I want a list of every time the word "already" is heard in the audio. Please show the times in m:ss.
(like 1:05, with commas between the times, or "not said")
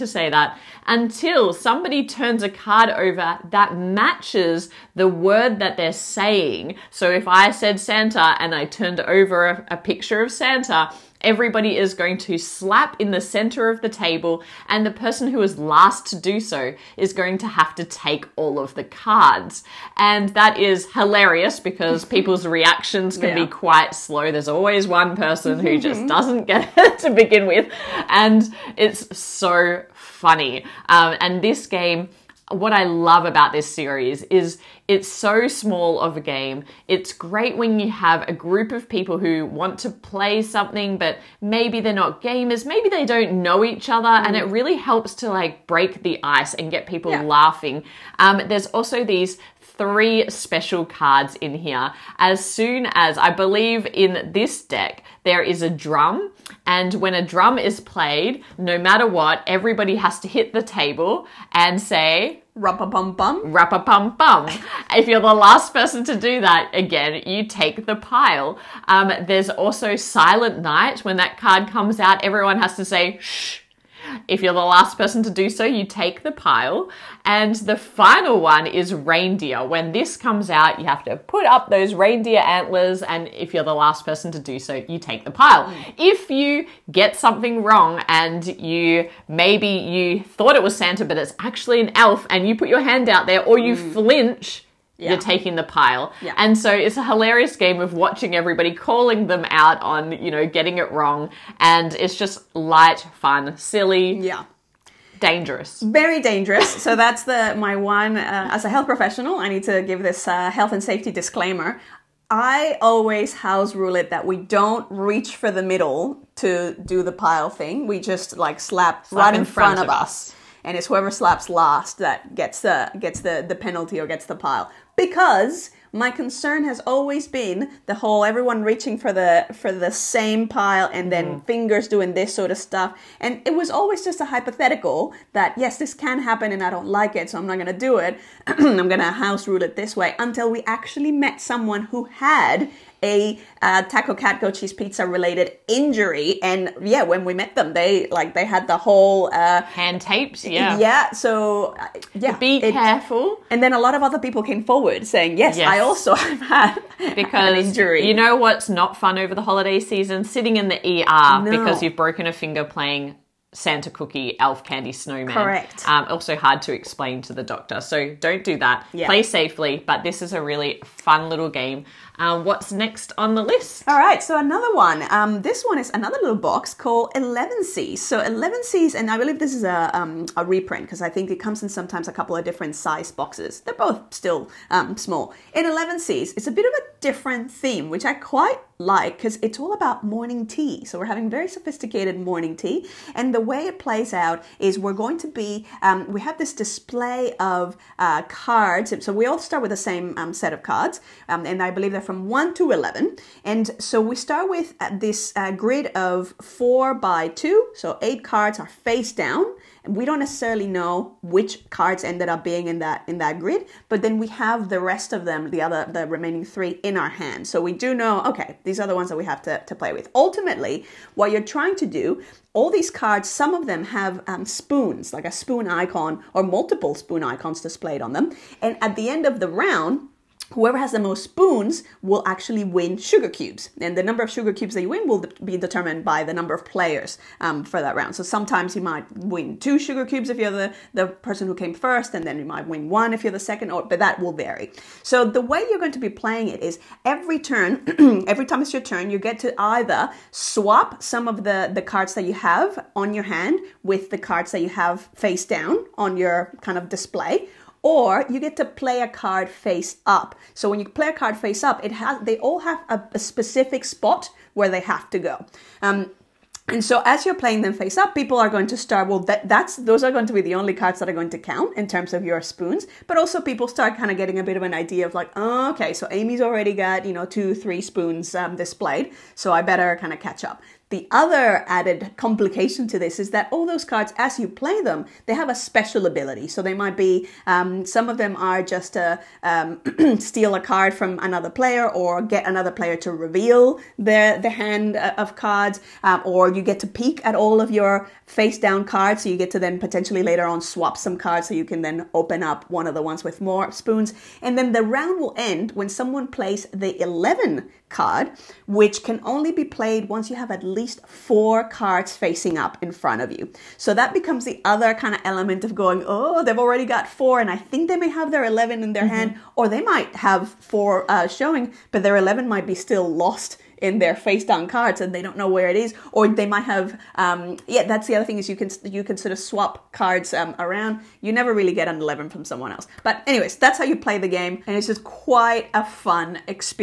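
4:36, 5:16.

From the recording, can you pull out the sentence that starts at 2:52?
Uh, what's next on the list?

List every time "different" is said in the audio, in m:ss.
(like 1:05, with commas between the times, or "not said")
3:02, 3:06.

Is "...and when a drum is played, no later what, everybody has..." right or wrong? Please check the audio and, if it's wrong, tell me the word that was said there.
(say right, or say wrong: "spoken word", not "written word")
wrong: "matter", not "later".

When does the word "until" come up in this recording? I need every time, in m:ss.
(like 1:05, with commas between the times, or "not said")
0:00, 2:20.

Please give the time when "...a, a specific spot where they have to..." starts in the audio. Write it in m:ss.
4:22.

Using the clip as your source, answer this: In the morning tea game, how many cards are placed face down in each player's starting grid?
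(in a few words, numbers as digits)
8.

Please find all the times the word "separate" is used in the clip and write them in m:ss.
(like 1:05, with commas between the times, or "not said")
not said.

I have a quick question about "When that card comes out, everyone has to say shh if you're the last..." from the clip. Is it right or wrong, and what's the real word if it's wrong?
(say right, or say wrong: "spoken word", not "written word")
right.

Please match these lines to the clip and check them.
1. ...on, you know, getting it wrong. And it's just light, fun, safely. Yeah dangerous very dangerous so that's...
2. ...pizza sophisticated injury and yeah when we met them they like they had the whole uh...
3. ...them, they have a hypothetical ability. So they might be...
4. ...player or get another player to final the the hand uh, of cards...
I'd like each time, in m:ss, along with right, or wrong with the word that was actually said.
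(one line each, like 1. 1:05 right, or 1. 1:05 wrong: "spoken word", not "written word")
1. 1:39 wrong: "silly", not "safely"
2. 2:24 wrong: "related", not "sophisticated"
3. 4:44 wrong: "special", not "hypothetical"
4. 4:51 wrong: "reveal", not "final".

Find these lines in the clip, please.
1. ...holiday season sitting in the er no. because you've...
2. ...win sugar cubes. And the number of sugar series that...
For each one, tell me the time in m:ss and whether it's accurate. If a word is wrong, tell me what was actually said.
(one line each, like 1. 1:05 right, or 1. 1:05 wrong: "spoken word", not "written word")
1. 2:39 right
2. 3:52 wrong: "cubes", not "series".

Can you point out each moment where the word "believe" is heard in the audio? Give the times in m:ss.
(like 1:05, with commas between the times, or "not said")
0:53, 2:59, 3:21.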